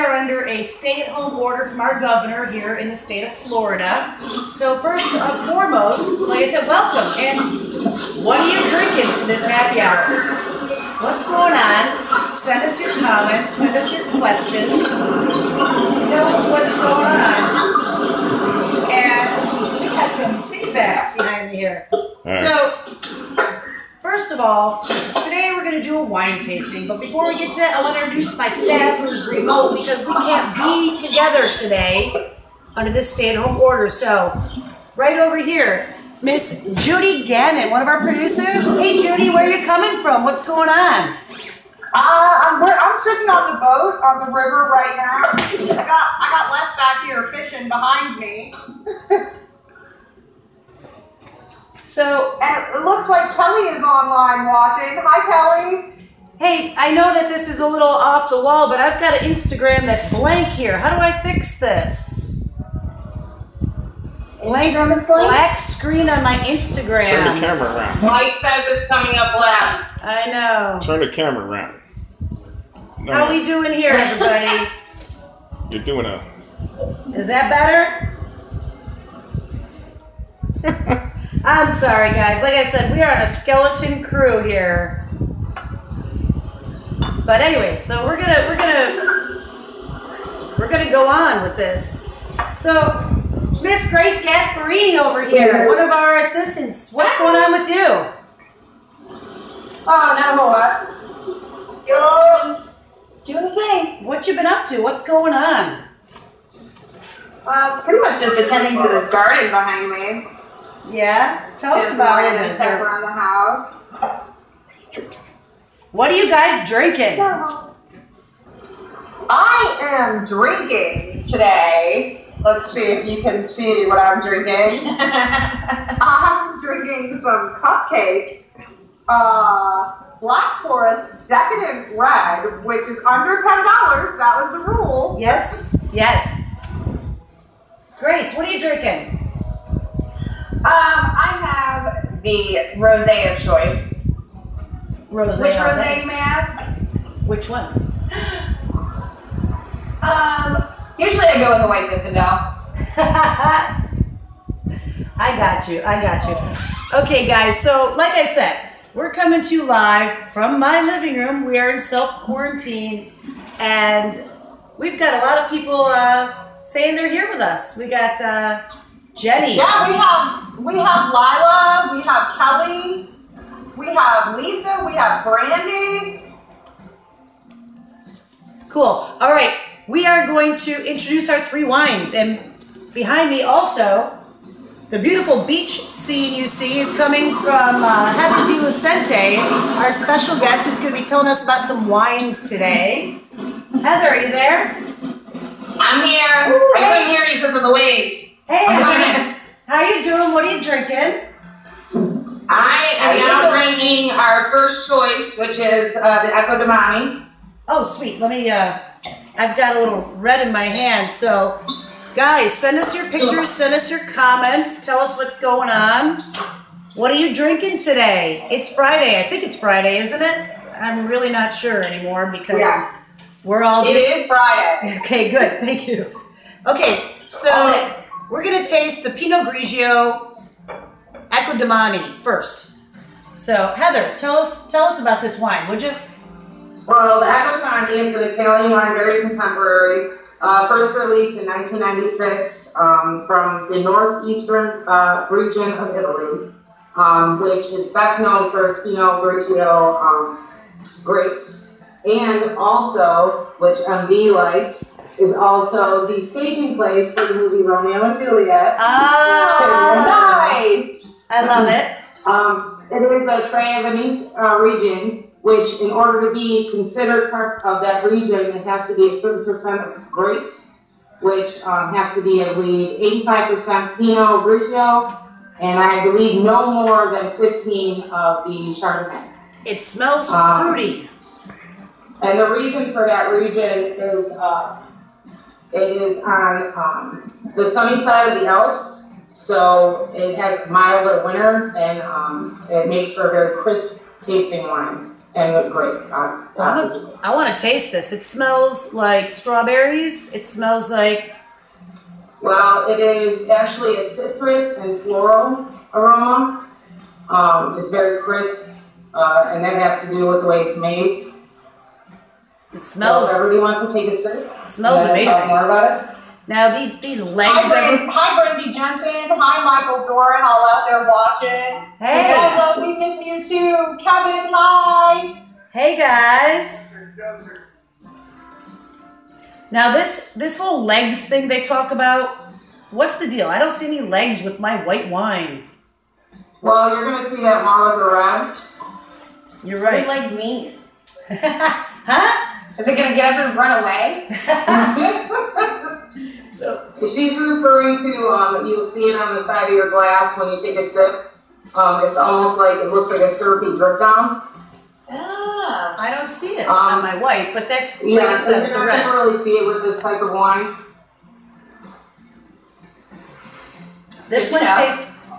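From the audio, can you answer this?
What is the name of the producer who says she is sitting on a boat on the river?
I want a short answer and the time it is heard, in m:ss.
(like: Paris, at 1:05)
Judy Gannon, at 0:36.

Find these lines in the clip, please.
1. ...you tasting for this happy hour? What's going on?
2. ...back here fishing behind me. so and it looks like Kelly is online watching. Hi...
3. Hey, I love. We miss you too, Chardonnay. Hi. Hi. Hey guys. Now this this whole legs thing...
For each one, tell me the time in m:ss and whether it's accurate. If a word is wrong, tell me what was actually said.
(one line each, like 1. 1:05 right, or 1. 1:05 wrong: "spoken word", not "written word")
1. 0:08 wrong: "drinking", not "tasting"
2. 0:46 right
3. 5:22 wrong: "Kevin", not "Chardonnay".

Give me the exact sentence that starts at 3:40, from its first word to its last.
I'm really not sure anymore because yeah.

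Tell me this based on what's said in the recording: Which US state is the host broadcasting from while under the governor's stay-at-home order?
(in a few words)
Florida.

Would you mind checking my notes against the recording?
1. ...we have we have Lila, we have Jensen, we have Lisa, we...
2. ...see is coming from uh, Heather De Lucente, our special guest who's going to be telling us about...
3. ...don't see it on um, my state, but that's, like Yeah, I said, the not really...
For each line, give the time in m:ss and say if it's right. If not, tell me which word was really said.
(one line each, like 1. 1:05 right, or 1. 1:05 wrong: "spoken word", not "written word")
1. 2:49 wrong: "Kelly", not "Jensen"
2. 3:06 right
3. 5:56 wrong: "white", not "state".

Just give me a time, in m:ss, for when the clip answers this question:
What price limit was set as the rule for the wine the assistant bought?
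2:13.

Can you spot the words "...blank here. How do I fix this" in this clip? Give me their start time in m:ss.
1:00.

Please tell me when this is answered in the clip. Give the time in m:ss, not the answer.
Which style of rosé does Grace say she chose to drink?
2:31.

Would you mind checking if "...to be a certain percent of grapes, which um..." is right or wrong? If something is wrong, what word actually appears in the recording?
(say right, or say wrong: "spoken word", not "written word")
right.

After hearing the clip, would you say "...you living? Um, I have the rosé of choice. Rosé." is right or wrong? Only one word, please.
wrong.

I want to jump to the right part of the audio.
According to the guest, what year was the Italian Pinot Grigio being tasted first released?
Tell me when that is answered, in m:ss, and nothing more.
4:01.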